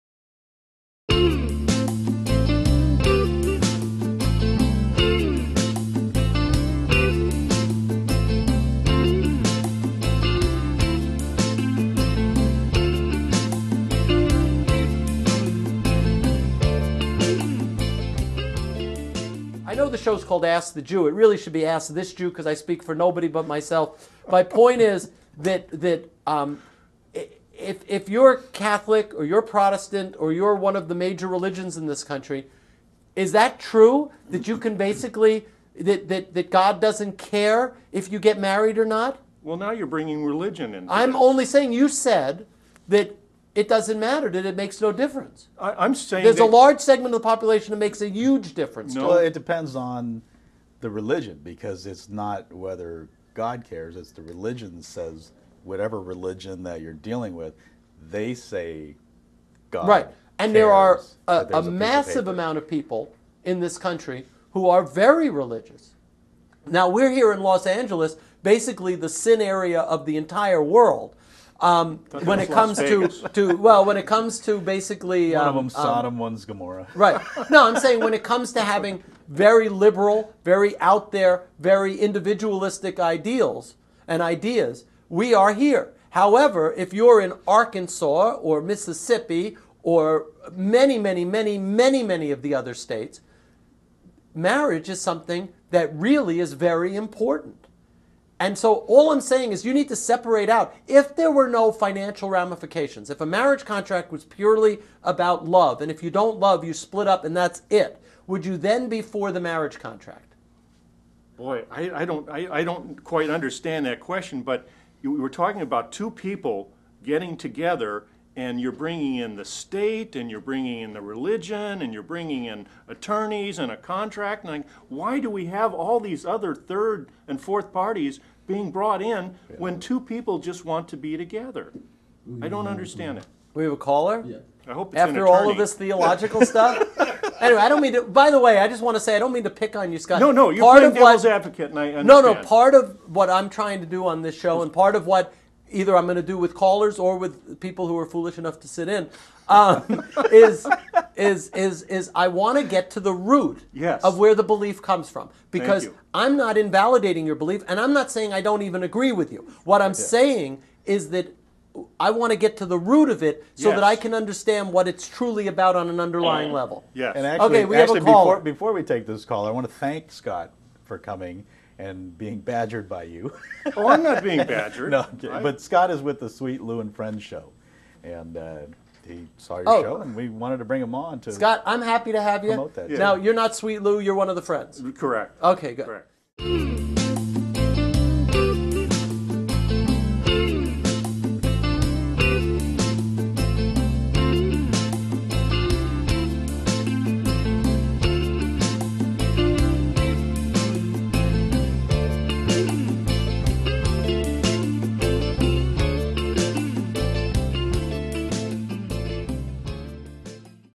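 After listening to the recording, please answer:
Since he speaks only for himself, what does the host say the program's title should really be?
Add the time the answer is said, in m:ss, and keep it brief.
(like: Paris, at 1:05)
Ask This Jew, at 0:21.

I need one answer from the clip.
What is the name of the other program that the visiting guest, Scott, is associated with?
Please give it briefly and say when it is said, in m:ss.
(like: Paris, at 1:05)
Sweet Lou and Friends, at 2:56.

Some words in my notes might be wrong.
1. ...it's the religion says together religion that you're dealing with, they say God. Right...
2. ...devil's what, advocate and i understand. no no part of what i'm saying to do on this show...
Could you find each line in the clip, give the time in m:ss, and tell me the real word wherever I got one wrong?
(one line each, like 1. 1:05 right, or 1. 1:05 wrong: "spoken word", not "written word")
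1. 0:53 wrong: "whatever", not "together"
2. 2:20 wrong: "trying", not "saying".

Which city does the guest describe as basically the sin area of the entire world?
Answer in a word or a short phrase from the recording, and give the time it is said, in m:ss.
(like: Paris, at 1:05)
Los Angeles, at 1:07.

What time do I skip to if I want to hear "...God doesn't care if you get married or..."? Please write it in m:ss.
0:36.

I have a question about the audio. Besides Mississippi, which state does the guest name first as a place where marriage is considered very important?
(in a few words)
Arkansas.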